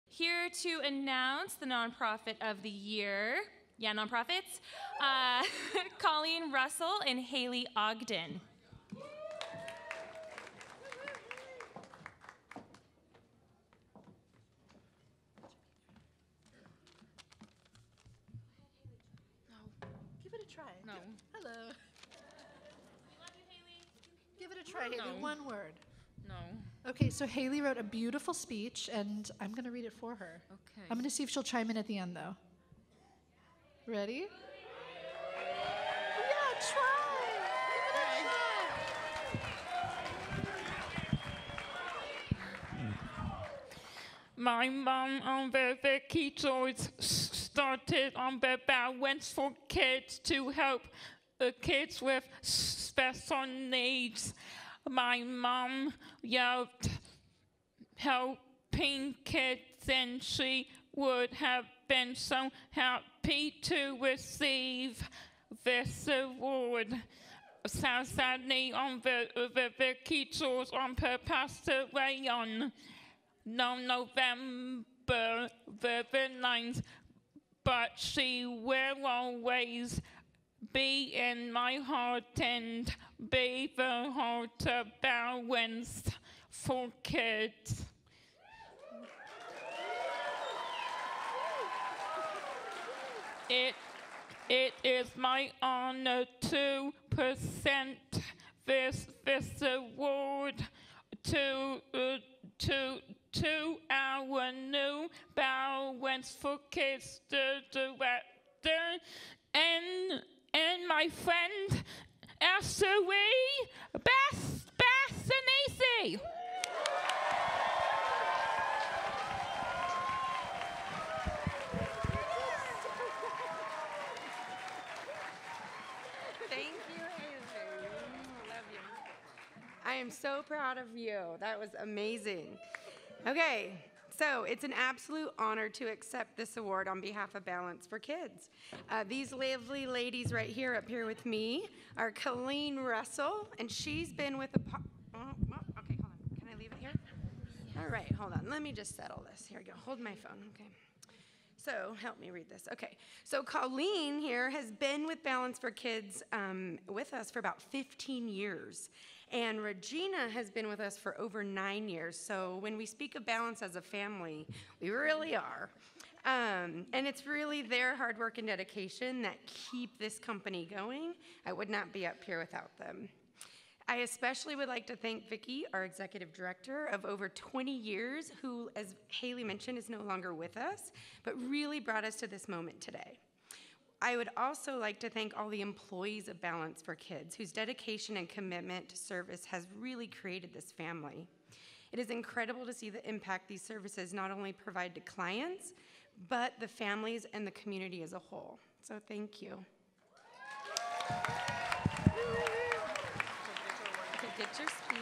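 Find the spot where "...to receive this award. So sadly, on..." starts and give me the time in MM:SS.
01:03.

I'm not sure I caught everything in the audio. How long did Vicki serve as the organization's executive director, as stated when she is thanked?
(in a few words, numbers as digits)
over 20 years.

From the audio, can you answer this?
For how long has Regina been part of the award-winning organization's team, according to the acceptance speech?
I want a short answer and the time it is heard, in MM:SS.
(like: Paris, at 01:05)
over 9 years, at 02:41.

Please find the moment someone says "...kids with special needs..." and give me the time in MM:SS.
00:51.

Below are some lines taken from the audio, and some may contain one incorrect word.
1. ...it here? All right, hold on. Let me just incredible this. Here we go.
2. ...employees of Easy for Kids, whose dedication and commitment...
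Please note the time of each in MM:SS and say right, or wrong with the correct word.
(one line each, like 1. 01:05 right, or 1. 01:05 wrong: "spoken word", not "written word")
1. 02:26 wrong: "settle", not "incredible"
2. 03:05 wrong: "Balance", not "Easy".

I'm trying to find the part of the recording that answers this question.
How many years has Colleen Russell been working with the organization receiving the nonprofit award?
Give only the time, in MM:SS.
02:37.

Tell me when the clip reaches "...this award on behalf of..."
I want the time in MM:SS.
02:16.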